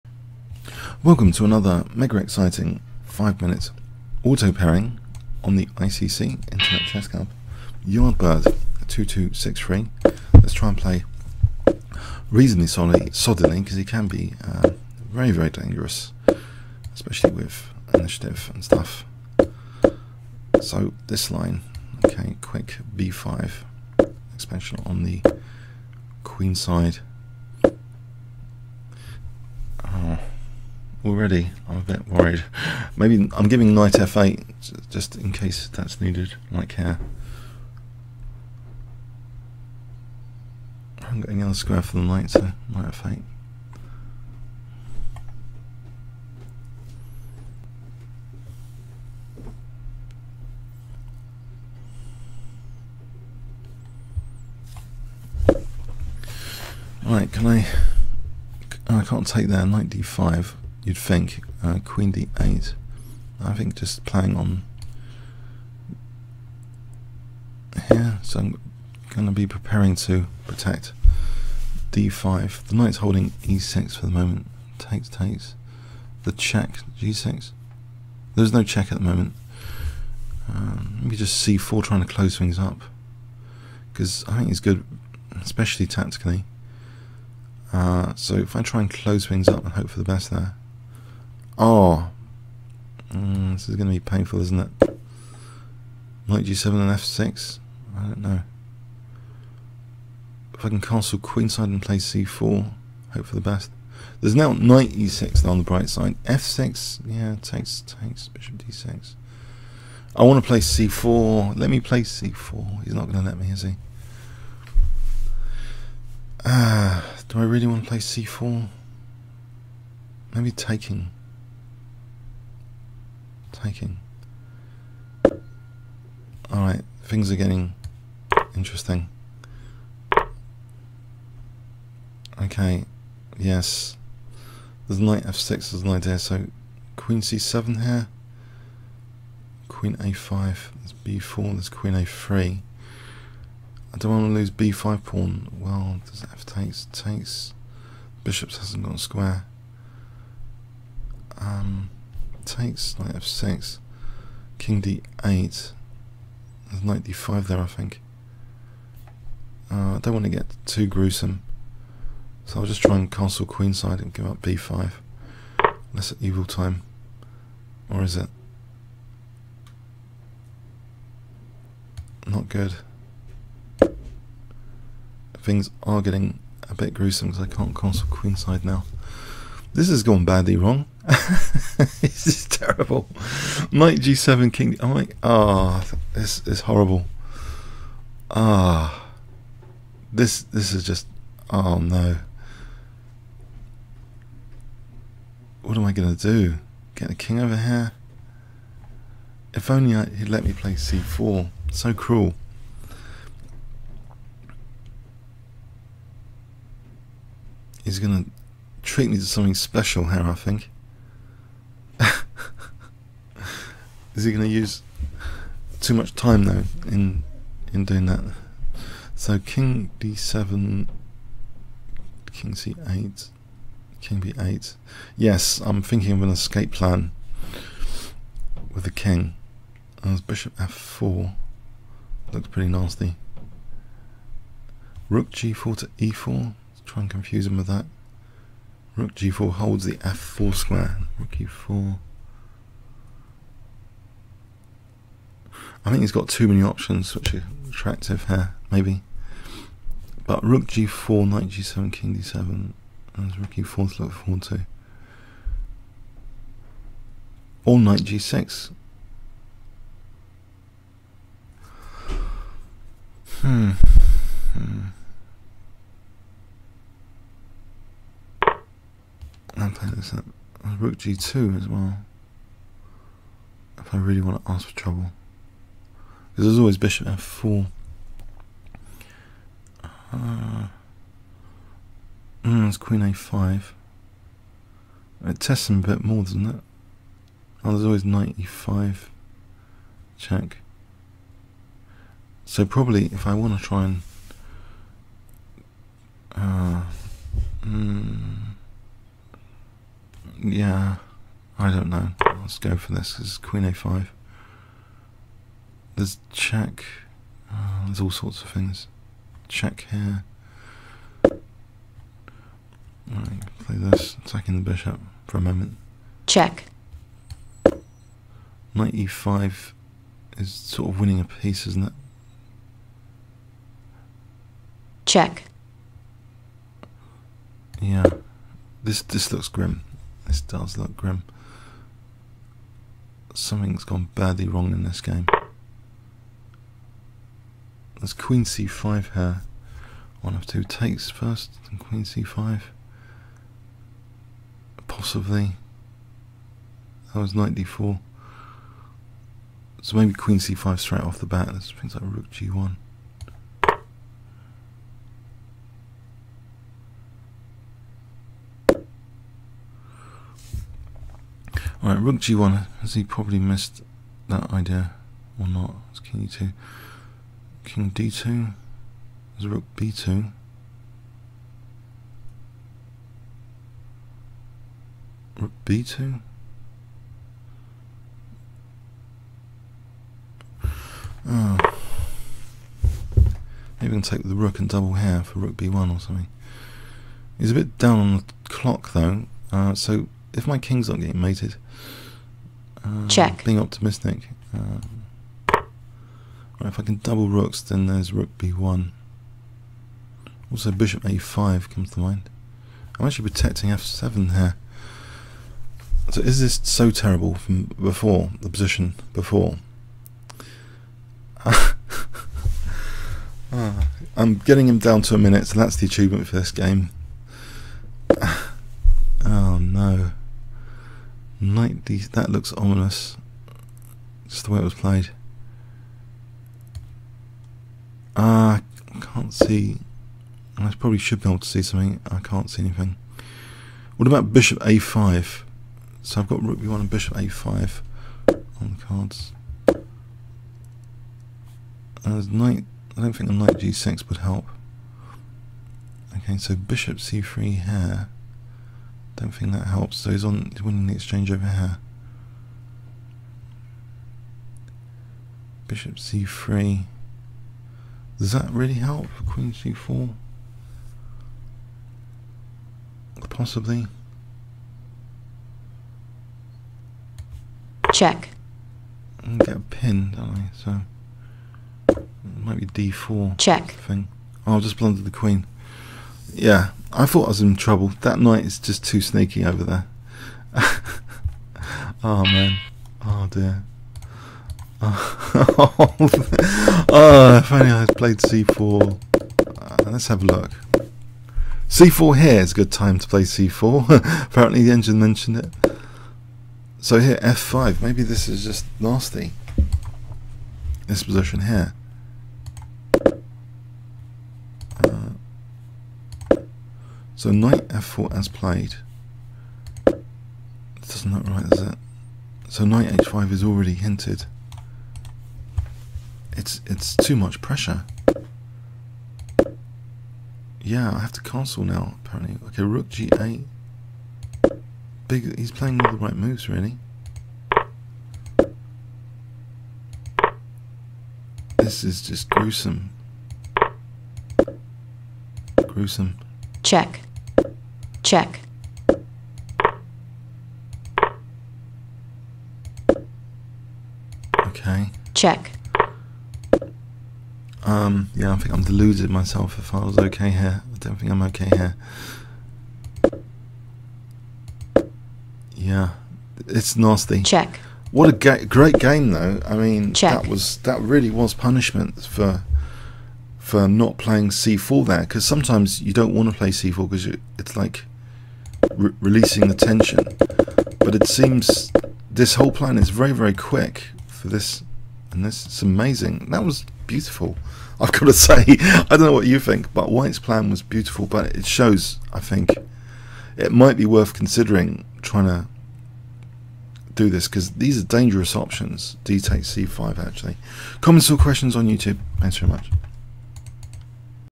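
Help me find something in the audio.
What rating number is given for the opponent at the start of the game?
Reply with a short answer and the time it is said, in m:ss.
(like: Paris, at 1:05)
2263, at 0:08.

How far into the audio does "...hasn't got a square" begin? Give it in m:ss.
2:28.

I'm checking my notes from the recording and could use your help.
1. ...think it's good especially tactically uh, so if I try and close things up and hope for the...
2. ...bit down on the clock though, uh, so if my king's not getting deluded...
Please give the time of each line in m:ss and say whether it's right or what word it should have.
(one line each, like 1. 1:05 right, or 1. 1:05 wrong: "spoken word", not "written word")
1. 1:24 right
2. 6:27 wrong: "mated", not "deluded".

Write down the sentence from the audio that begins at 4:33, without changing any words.
If I really want to ask for trouble.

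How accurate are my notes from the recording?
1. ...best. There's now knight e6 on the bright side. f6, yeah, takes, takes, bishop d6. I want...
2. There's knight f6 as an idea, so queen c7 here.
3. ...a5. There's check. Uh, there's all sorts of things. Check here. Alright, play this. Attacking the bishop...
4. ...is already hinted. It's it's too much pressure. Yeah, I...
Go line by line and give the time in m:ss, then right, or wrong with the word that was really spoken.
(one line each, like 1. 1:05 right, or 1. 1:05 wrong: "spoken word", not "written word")
1. 1:43 right
2. 2:14 right
3. 5:03 right
4. 8:33 right.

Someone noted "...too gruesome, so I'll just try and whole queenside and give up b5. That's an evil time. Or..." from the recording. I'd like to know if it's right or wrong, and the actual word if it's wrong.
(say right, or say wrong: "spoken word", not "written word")
wrong: "castle", not "whole".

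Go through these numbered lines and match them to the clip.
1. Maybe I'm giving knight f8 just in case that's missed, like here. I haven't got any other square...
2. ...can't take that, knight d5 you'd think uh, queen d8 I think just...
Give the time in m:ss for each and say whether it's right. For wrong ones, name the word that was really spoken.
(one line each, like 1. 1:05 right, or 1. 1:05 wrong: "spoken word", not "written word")
1. 0:32 wrong: "needed", not "missed"
2. 0:59 right.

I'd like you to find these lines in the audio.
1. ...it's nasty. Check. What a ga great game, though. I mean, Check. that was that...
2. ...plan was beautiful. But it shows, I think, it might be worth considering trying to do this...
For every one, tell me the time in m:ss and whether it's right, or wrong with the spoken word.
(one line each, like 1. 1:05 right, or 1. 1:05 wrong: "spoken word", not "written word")
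1. 9:16 right
2. 9:40 right.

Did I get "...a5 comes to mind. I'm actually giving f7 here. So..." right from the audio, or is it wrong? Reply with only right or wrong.
wrong.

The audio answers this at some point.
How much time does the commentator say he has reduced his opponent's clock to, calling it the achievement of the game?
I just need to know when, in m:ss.
6:55.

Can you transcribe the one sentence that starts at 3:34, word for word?
is he going to use too much time though in in doing that?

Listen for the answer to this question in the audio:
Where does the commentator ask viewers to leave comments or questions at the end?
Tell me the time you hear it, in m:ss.
9:51.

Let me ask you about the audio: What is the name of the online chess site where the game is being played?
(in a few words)
Internet Chess Club.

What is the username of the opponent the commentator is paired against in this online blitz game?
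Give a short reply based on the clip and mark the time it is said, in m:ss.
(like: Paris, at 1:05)
Yardbird, at 0:07.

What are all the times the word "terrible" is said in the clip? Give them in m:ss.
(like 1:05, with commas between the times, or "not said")
3:02, 6:46.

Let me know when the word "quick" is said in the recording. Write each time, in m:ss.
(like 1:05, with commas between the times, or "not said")
0:22, 9:33.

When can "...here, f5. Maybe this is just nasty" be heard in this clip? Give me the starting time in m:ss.
8:16.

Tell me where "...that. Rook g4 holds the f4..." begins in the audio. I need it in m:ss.
3:57.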